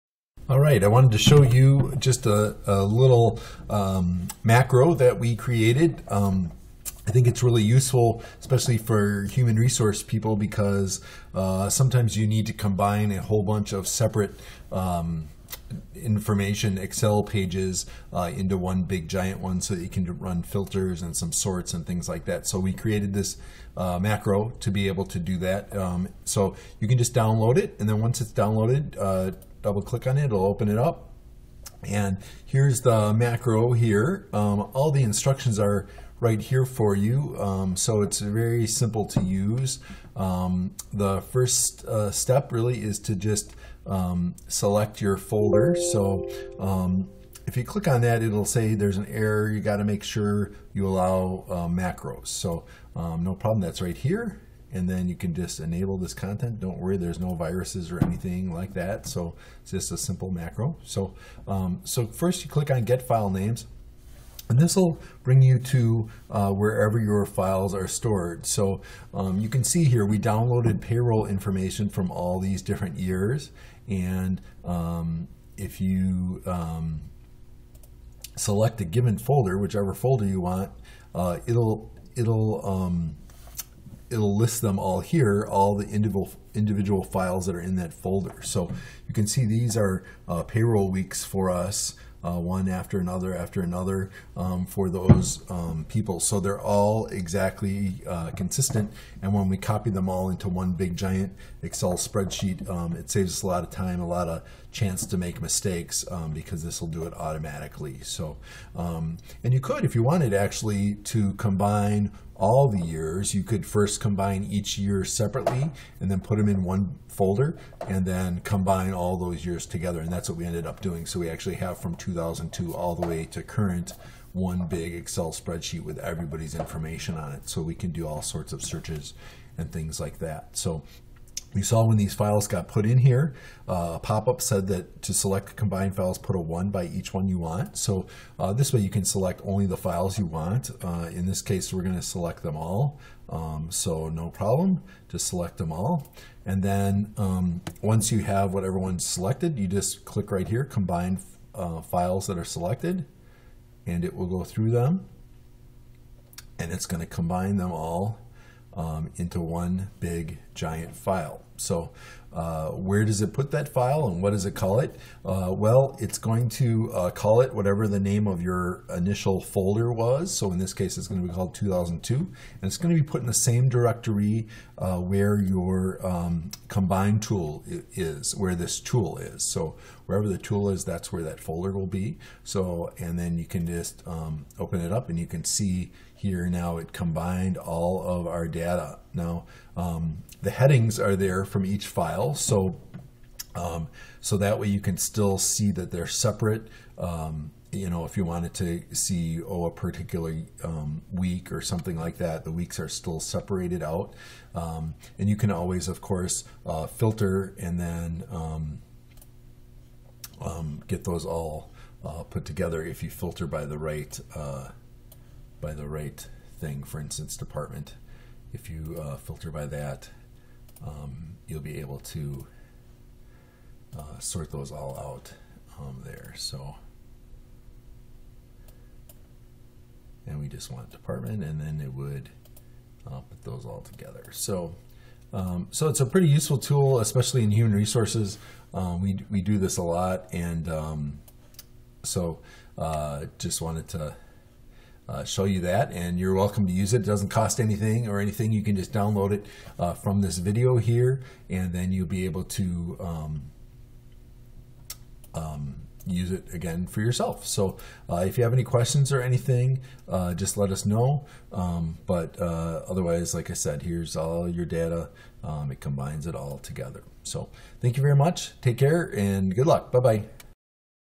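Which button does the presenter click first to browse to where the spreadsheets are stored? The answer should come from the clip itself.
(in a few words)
Get file names.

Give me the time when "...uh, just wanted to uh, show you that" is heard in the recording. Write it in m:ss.
4:02.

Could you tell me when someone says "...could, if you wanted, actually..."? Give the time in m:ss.
1:49.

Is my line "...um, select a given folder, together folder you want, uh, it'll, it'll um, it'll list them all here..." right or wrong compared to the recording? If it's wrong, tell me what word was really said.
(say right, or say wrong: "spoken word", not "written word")
wrong: "whichever", not "together".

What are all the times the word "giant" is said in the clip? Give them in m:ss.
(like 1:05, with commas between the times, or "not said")
0:19, 1:40, 2:40.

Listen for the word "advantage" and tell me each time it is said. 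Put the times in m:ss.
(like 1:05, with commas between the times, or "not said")
not said.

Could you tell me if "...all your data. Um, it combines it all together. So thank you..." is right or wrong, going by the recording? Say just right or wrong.
right.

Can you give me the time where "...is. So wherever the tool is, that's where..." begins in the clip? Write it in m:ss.
2:59.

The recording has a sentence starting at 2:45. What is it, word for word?
Uh, well, it's going to uh, call it whatever the name of your initial folder was.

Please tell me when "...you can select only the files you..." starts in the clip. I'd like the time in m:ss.
2:18.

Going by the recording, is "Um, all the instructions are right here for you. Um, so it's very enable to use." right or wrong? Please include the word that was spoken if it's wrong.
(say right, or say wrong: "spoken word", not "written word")
wrong: "simple", not "enable".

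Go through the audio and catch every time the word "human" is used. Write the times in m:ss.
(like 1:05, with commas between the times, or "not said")
0:09, 3:57.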